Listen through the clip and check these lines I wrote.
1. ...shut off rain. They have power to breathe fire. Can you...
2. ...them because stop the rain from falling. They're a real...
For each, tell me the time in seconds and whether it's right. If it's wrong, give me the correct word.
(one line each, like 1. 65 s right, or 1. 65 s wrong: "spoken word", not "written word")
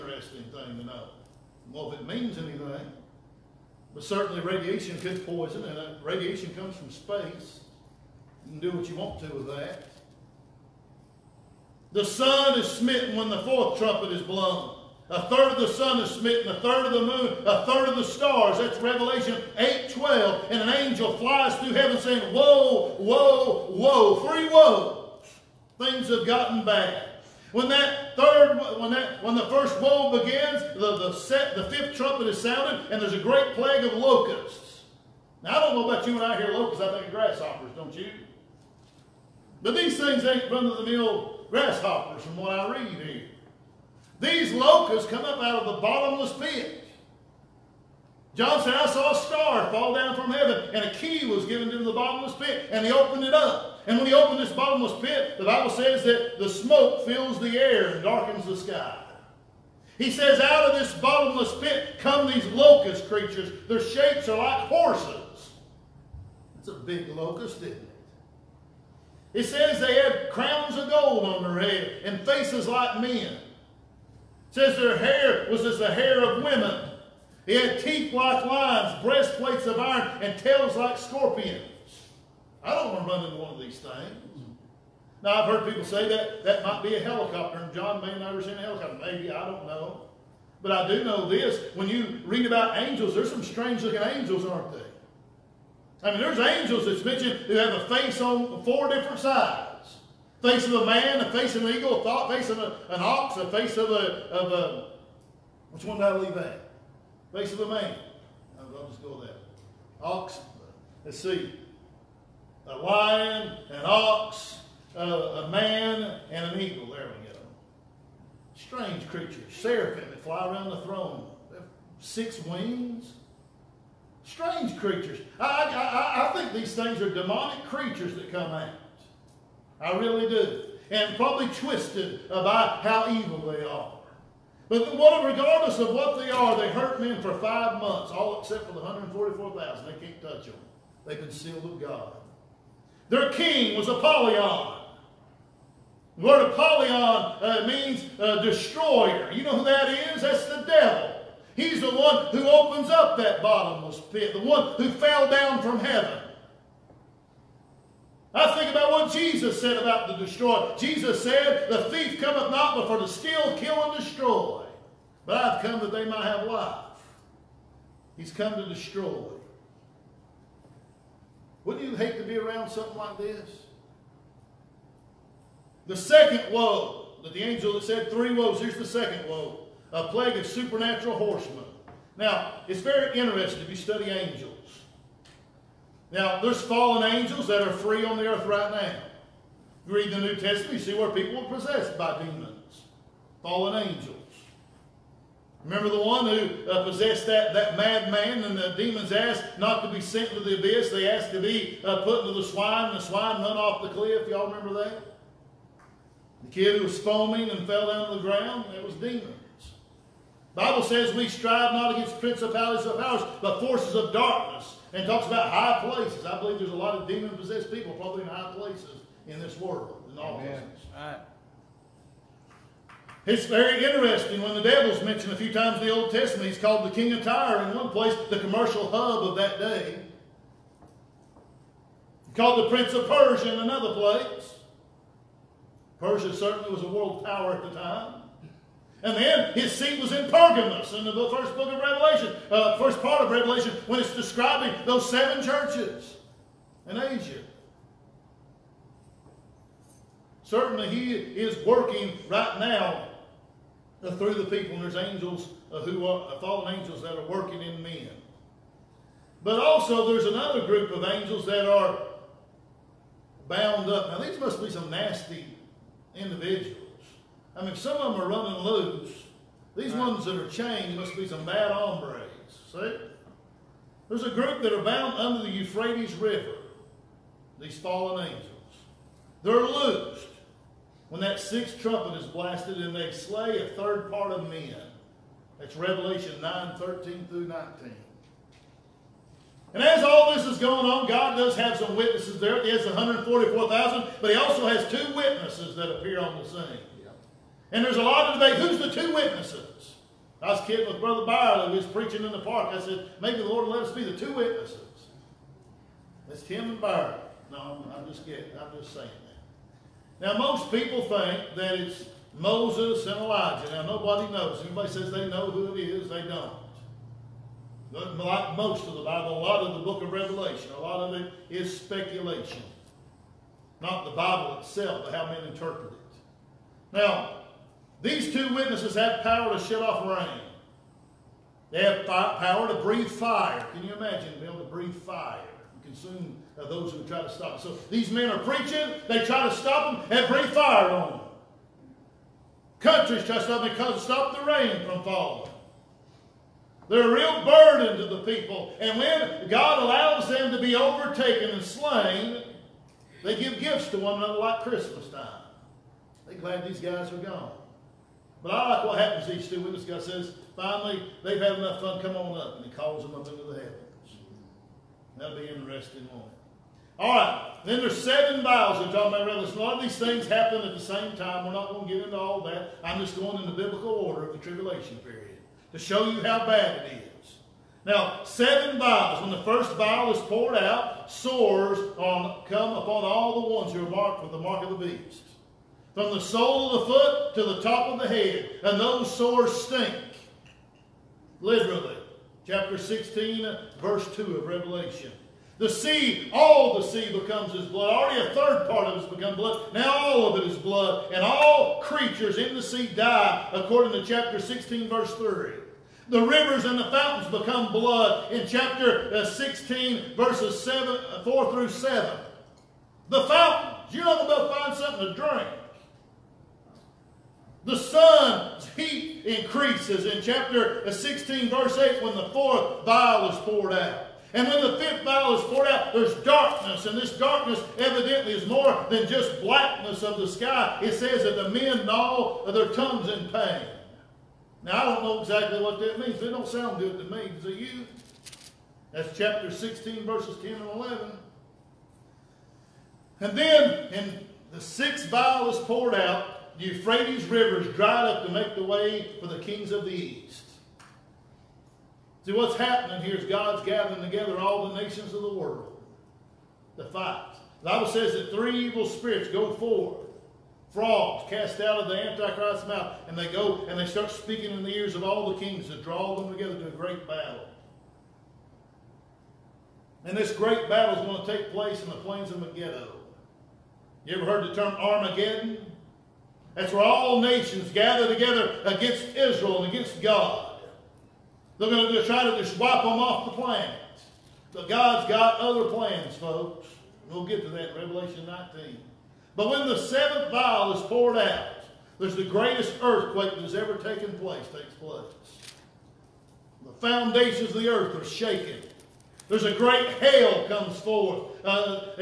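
1. 329 s right
2. 343 s right.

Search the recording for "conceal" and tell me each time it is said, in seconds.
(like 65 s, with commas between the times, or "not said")
141 s.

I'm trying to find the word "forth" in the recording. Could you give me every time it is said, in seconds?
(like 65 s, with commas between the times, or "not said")
459 s, 500 s.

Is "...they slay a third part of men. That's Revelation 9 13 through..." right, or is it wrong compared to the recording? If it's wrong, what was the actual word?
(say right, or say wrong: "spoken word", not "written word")
right.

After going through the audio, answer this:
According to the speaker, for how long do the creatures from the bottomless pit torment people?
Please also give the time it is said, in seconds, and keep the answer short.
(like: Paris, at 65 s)
5 months, at 137 s.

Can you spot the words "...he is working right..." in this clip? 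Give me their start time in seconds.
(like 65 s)
250 s.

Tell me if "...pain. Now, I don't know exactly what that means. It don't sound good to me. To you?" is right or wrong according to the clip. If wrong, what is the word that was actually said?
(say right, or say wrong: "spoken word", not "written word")
right.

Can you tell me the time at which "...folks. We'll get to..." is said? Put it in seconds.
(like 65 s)
486 s.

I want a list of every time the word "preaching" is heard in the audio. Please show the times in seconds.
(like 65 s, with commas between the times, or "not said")
301 s, 338 s.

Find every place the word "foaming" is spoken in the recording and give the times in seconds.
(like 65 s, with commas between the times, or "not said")
206 s.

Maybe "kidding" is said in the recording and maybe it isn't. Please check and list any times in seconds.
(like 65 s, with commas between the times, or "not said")
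300 s, 308 s.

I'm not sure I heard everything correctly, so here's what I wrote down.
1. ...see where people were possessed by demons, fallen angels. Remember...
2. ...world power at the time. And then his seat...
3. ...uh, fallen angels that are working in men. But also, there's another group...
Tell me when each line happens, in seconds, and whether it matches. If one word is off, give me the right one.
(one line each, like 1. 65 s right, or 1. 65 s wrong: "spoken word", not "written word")
1. 190 s right
2. 236 s right
3. 256 s right.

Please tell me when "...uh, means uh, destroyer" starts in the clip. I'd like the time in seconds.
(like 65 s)
146 s.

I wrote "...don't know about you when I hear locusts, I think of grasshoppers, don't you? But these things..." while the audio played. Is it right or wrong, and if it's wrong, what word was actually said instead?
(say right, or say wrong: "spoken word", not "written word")
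right.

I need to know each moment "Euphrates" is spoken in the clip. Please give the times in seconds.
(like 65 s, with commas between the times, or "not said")
275 s, 446 s.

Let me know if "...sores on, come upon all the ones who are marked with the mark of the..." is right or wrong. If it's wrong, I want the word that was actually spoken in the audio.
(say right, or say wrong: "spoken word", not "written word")
right.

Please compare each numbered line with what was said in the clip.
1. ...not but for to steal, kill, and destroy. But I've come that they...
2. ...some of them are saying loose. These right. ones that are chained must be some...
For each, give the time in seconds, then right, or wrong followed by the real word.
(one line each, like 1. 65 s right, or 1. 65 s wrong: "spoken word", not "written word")
1. 162 s right
2. 267 s wrong: "running", not "saying".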